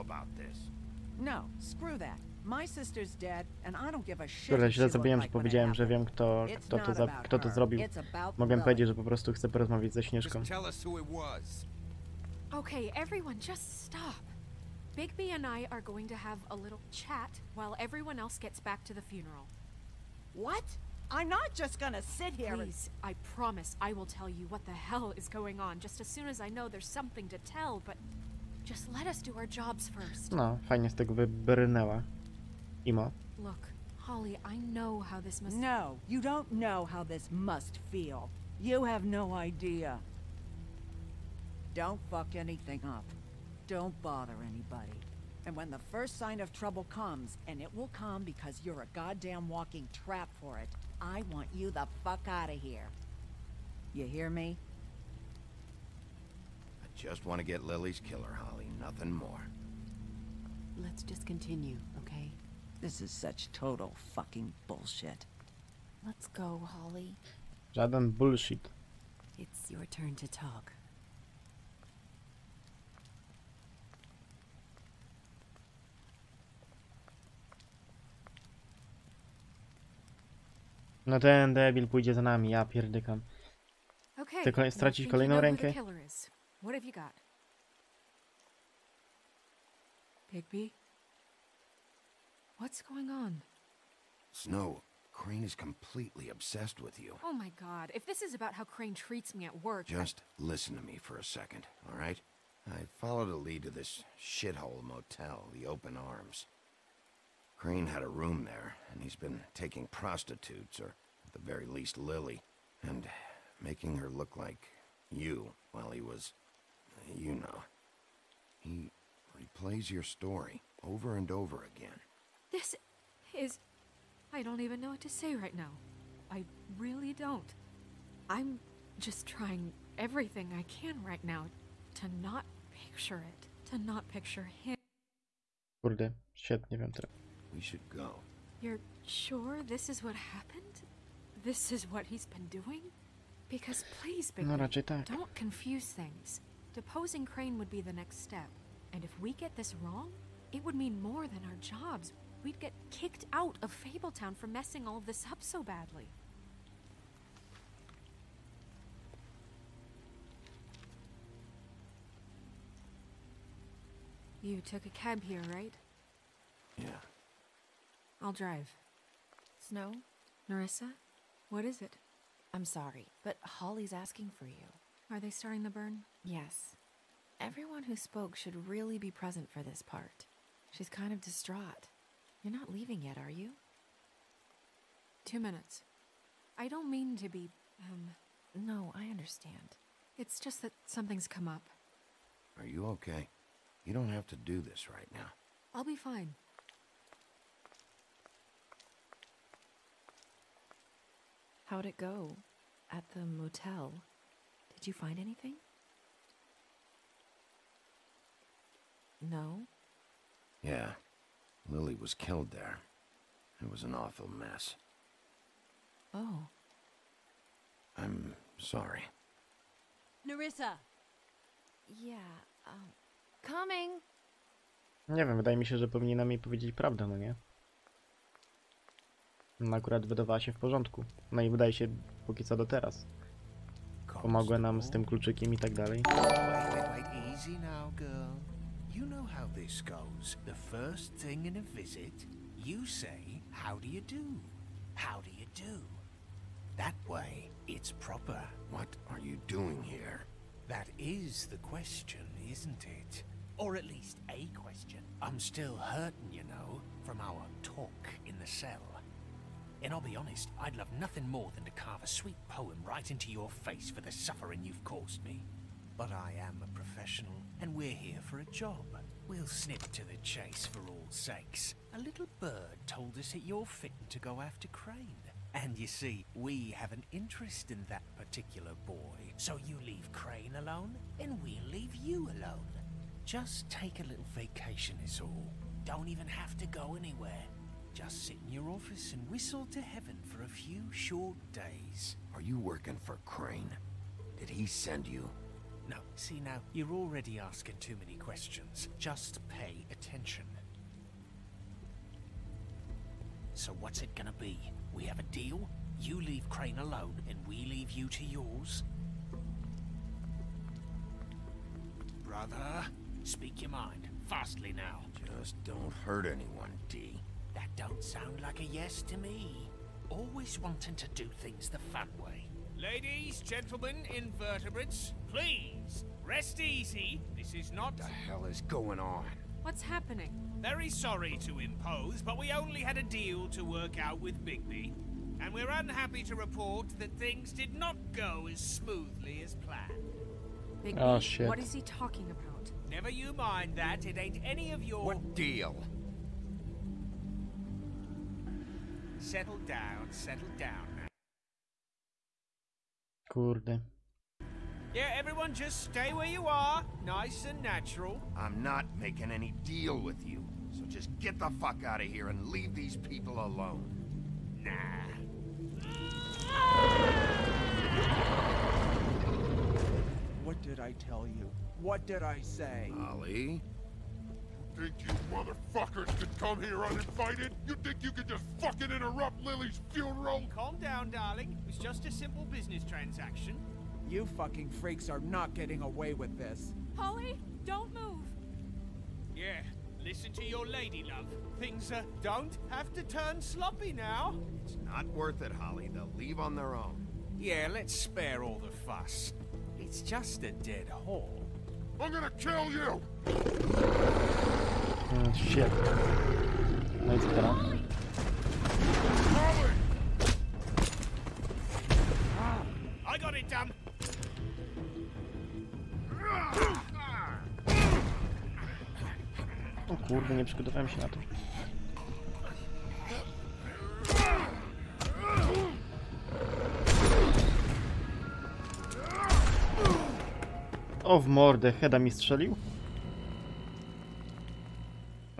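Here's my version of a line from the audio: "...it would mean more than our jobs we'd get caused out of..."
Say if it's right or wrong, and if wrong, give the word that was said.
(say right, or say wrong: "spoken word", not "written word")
wrong: "kicked", not "caused".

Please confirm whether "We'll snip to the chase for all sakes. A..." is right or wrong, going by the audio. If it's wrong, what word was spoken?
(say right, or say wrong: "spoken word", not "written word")
right.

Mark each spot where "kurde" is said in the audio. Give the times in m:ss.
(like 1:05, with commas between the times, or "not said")
0:04, 5:53, 6:59.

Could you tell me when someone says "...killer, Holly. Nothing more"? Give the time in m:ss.
0:57.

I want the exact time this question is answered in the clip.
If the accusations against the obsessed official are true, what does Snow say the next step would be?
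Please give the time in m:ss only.
2:26.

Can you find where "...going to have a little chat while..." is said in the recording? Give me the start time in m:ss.
0:15.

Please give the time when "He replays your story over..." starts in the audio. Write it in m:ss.
1:58.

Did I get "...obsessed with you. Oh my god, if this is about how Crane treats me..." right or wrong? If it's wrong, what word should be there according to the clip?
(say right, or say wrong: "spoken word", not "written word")
right.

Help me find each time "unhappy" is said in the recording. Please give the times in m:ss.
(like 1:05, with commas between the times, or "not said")
5:35.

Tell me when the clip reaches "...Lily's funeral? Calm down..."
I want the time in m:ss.
6:19.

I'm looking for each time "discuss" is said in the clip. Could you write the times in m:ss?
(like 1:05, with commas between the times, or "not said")
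not said.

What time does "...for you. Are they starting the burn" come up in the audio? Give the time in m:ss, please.
2:54.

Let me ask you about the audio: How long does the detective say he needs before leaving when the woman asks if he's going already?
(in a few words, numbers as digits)
Two minutes.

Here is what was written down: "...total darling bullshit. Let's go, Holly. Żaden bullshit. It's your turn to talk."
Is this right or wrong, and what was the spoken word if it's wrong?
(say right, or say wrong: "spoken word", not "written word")
wrong: "fucking", not "darling".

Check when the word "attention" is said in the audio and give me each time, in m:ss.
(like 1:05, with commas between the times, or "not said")
4:59.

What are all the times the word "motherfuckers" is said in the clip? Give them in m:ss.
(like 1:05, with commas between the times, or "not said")
6:15.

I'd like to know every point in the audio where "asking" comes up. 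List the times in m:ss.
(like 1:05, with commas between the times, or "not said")
2:53, 4:57.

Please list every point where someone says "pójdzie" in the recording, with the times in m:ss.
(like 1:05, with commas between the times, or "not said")
1:21.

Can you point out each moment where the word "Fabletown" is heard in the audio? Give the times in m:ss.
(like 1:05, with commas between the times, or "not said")
2:33.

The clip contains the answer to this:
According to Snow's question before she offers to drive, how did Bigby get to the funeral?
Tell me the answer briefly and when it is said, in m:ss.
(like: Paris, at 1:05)
A cab, at 2:44.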